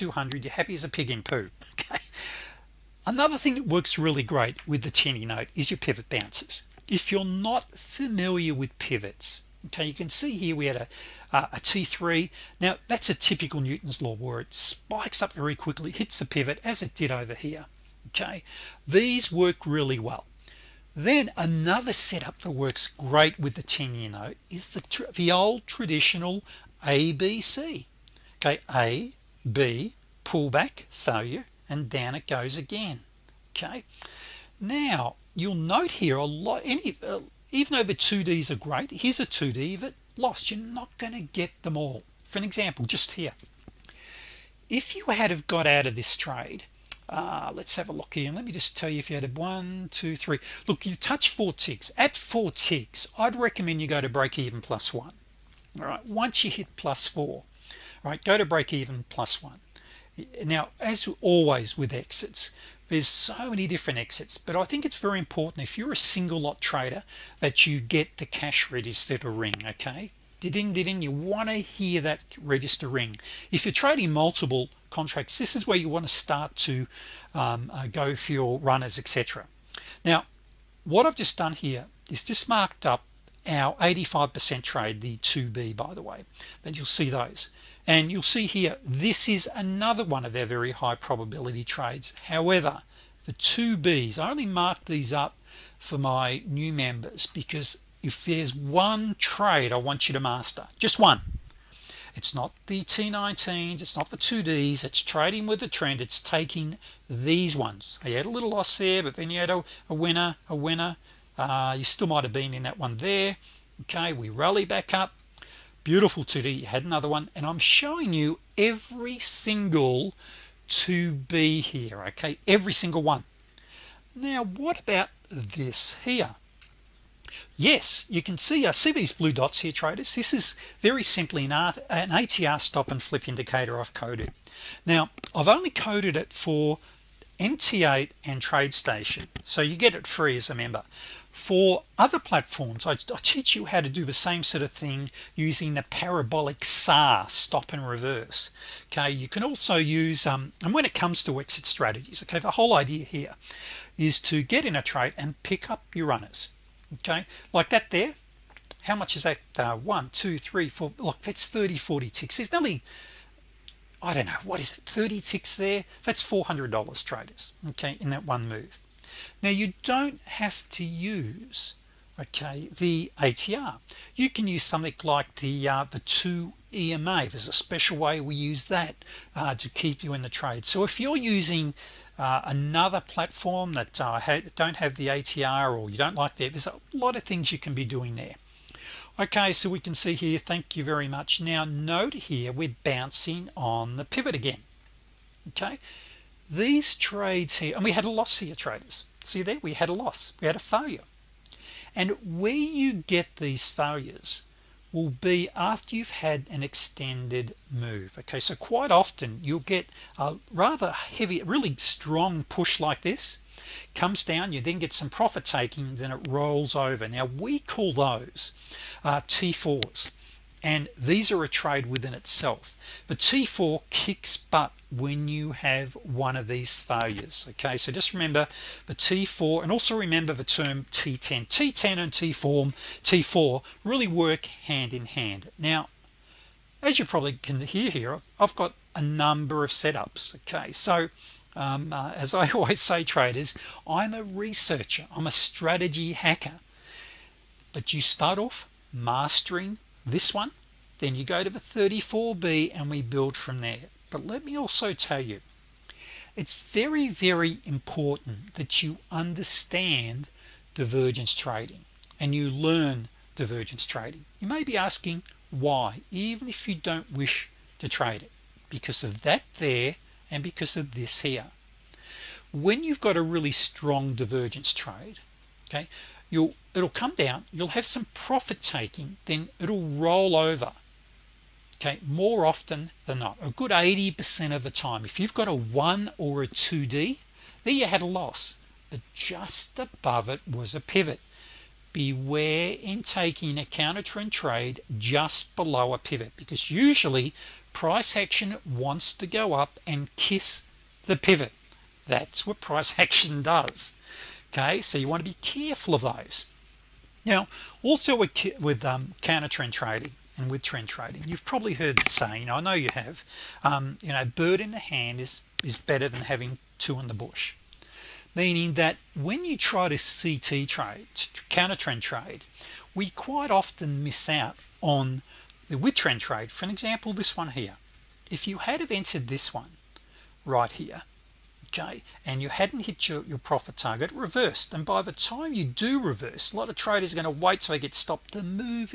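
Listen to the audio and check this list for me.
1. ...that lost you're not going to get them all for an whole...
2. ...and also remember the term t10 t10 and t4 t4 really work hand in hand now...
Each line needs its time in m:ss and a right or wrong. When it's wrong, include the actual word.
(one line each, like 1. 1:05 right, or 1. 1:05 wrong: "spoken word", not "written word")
1. 0:39 wrong: "example", not "whole"
2. 3:49 right.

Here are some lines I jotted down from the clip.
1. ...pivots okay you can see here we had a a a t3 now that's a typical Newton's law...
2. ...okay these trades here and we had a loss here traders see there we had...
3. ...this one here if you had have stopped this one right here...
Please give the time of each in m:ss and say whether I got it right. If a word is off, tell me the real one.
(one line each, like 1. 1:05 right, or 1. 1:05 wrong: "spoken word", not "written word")
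1. 0:08 right
2. 3:15 right
3. 5:27 wrong: "entered", not "stopped".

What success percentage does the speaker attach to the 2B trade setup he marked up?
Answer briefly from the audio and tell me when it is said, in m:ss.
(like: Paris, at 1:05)
85%, at 1:23.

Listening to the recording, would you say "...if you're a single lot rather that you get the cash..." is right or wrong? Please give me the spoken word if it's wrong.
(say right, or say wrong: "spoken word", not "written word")
wrong: "trader", not "rather".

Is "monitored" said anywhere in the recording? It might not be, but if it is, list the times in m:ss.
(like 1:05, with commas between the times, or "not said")
not said.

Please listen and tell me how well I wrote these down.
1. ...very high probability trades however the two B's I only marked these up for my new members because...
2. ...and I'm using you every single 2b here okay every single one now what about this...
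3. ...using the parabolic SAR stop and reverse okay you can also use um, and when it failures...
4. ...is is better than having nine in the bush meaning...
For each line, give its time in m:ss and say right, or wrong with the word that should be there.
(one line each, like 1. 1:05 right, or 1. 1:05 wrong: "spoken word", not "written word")
1. 1:30 right
2. 1:57 wrong: "showing", not "using"
3. 2:25 wrong: "comes", not "failures"
4. 5:15 wrong: "two", not "nine".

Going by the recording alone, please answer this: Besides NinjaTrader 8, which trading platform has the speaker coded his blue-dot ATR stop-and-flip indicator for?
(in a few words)
TradeStation.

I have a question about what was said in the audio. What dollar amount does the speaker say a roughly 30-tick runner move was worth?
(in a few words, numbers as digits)
$400.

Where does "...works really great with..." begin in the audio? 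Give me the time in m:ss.
0:03.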